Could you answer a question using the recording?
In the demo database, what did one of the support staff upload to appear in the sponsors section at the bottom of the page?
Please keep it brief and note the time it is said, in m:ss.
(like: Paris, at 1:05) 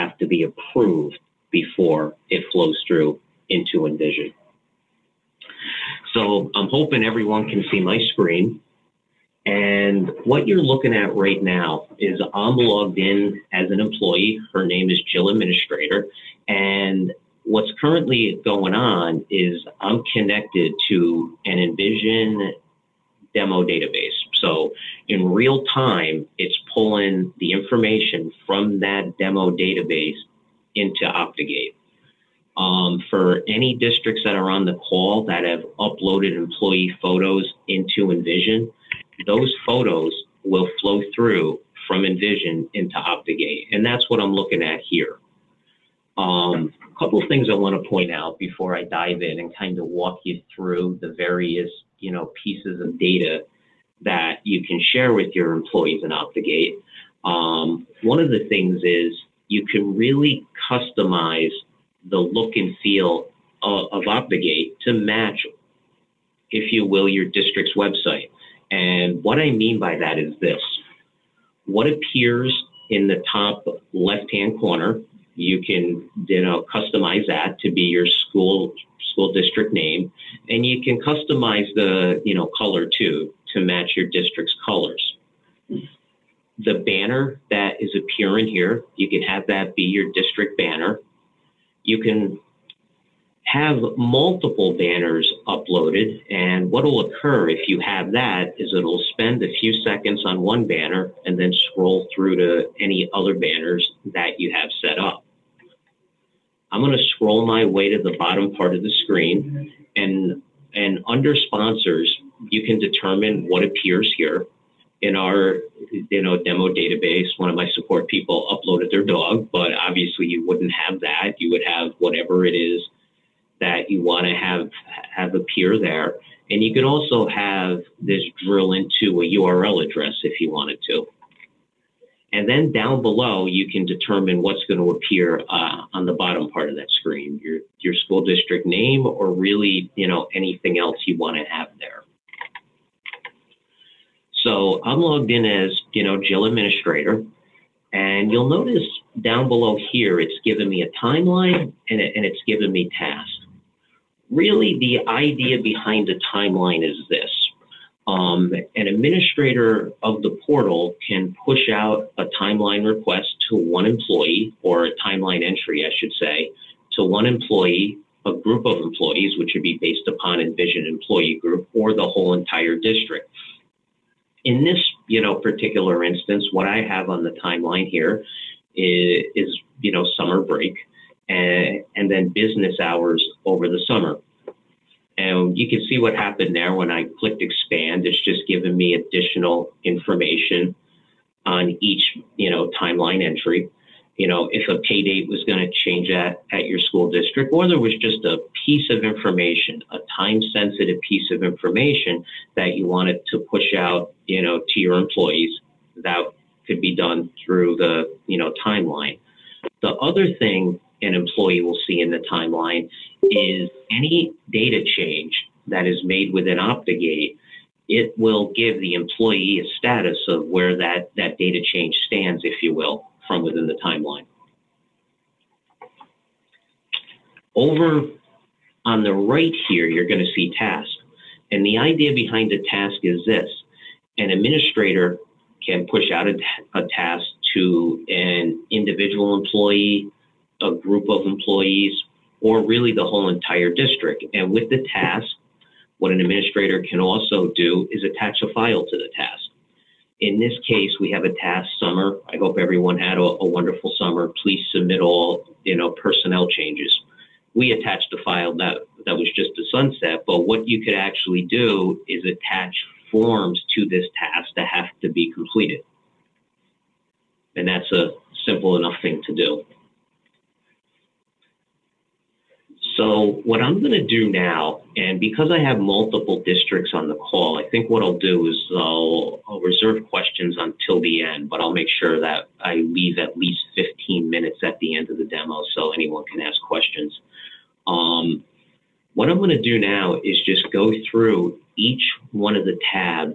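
their dog, at 1:58.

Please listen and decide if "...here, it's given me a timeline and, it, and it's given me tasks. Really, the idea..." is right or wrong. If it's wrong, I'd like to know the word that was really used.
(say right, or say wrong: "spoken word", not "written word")
right.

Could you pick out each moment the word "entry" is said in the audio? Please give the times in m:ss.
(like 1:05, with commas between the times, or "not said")
2:45, 3:13.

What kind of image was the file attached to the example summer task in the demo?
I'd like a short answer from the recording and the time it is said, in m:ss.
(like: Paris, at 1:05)
a sunset, at 4:19.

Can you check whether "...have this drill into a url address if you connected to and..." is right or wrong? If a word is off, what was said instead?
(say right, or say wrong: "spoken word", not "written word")
wrong: "wanted", not "connected".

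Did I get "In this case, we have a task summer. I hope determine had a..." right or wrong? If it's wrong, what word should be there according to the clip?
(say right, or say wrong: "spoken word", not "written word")
wrong: "everyone", not "determine".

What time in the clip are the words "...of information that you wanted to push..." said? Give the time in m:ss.
3:21.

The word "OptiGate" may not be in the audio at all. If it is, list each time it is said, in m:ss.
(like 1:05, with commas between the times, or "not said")
0:31, 0:42, 0:56, 1:04, 3:36.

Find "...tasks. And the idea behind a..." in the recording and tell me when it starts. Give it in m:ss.
3:50.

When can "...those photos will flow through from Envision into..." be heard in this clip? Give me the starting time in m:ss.
0:39.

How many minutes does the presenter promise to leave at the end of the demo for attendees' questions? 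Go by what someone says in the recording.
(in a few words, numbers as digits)
15.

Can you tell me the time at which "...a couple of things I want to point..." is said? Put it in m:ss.
0:46.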